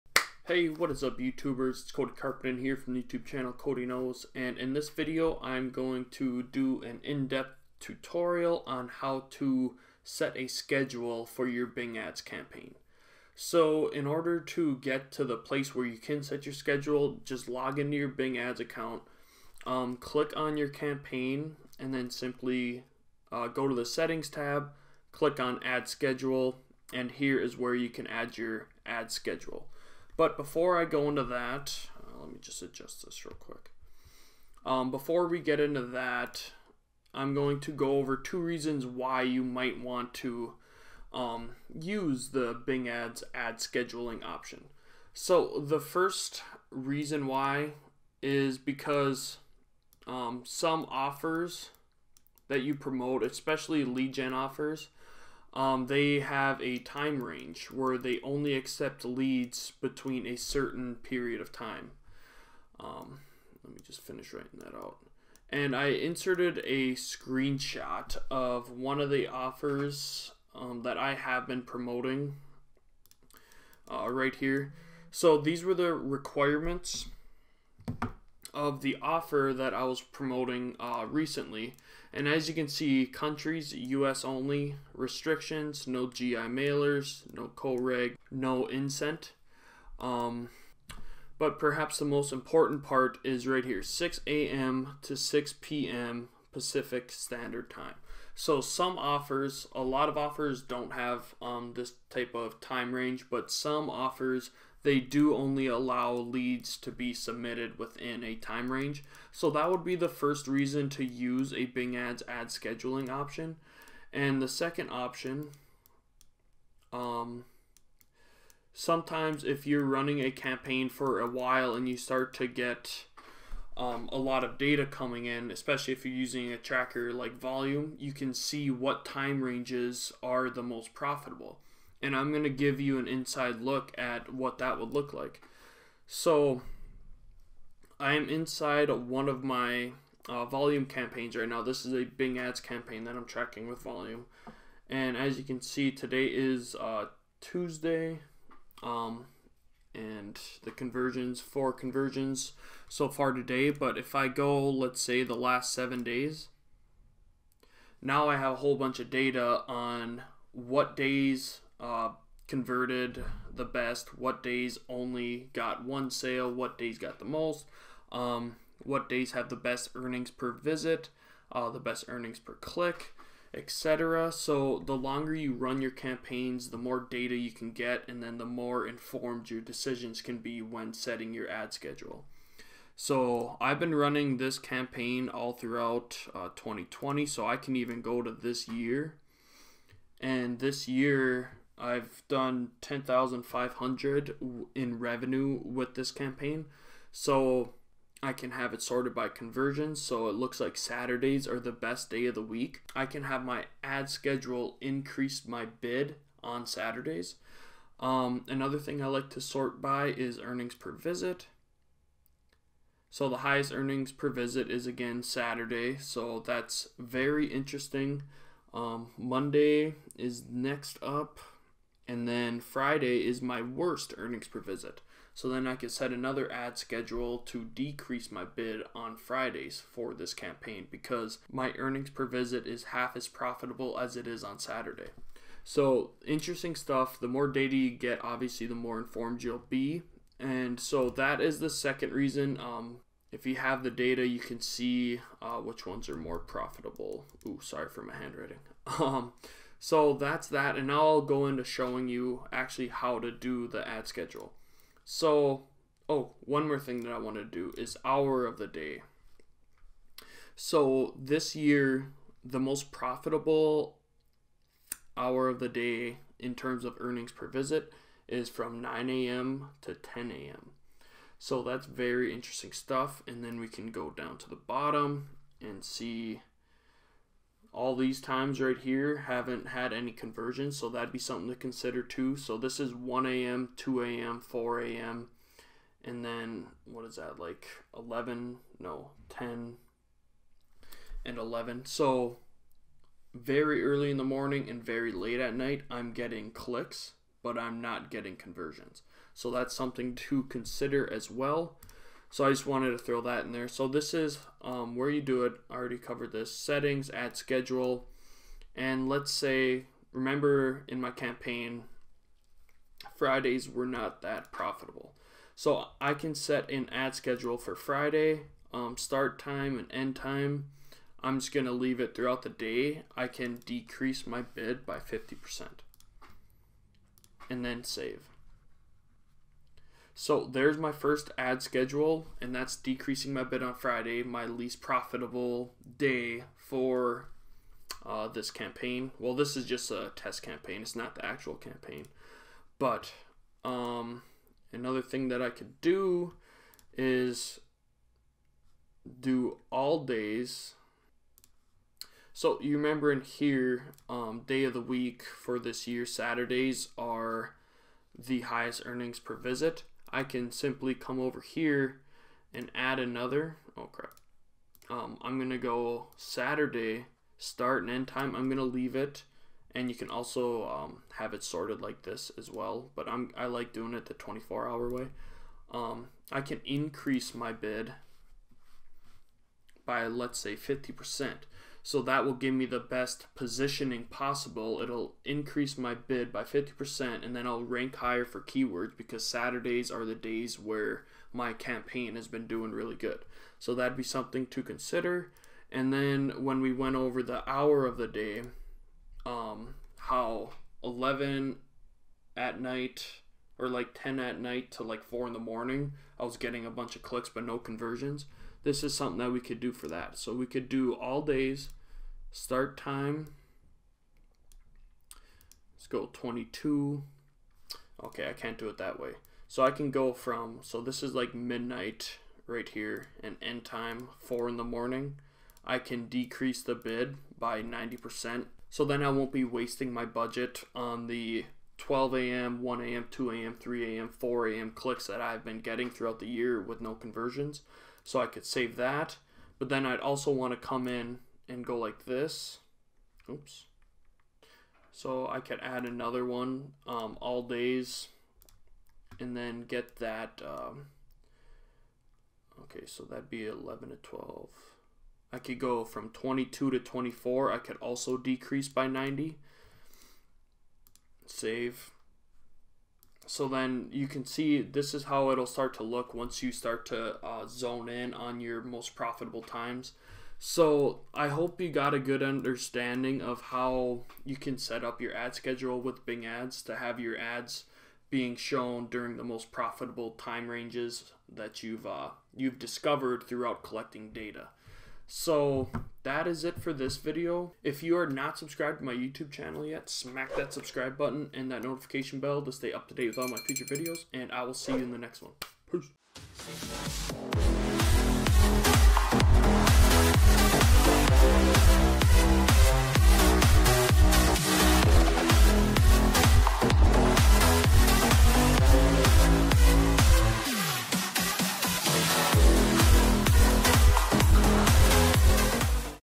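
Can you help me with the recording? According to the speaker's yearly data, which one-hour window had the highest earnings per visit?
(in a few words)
9 a.m. to 10 a.m.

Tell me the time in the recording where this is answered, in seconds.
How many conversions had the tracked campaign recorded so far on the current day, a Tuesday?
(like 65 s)
151 s.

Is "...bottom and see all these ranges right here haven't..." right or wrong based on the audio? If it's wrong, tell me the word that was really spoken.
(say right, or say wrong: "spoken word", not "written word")
wrong: "times", not "ranges".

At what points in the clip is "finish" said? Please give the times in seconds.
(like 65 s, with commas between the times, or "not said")
64 s.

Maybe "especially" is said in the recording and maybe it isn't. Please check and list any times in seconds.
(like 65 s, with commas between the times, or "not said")
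53 s, 125 s.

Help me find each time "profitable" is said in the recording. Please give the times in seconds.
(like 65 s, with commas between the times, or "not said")
130 s, 233 s, 246 s, 262 s, 314 s, 334 s, 468 s, 479 s.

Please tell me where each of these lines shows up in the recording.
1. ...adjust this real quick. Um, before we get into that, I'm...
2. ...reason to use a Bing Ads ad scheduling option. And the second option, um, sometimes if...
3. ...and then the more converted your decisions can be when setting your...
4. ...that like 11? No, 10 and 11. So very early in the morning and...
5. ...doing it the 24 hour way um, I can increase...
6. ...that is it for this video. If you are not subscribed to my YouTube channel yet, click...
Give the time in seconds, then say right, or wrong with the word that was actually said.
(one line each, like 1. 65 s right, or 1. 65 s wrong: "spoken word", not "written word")
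1. 32 s right
2. 110 s right
3. 178 s wrong: "informed", not "converted"
4. 287 s right
5. 373 s right
6. 486 s wrong: "smack", not "click".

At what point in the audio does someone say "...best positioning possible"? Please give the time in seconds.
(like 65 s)
382 s.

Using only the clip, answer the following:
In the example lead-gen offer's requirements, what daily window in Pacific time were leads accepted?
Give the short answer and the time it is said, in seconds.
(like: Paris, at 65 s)
6 a.m. to 6 p.m., at 93 s.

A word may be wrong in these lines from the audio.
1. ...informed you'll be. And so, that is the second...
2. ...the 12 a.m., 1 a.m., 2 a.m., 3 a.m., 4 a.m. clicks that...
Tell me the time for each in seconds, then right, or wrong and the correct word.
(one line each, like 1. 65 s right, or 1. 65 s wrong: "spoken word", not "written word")
1. 238 s right
2. 431 s right.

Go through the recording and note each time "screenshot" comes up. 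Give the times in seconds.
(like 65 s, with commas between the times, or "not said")
66 s.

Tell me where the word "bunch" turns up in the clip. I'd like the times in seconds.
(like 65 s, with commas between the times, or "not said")
158 s, 406 s.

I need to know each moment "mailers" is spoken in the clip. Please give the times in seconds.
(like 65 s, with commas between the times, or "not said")
86 s.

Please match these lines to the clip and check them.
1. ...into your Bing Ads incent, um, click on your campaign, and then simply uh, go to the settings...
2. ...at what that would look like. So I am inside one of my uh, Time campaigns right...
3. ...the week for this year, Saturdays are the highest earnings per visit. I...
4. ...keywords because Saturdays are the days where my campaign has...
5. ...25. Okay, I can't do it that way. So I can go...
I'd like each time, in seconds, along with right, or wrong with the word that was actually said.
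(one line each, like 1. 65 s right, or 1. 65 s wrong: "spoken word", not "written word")
1. 17 s wrong: "account", not "incent"
2. 133 s wrong: "Voluum", not "Time"
3. 354 s right
4. 388 s right
5. 416 s wrong: "22", not "25".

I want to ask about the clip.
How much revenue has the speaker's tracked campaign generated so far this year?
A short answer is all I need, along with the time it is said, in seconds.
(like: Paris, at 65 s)
10,500, at 192 s.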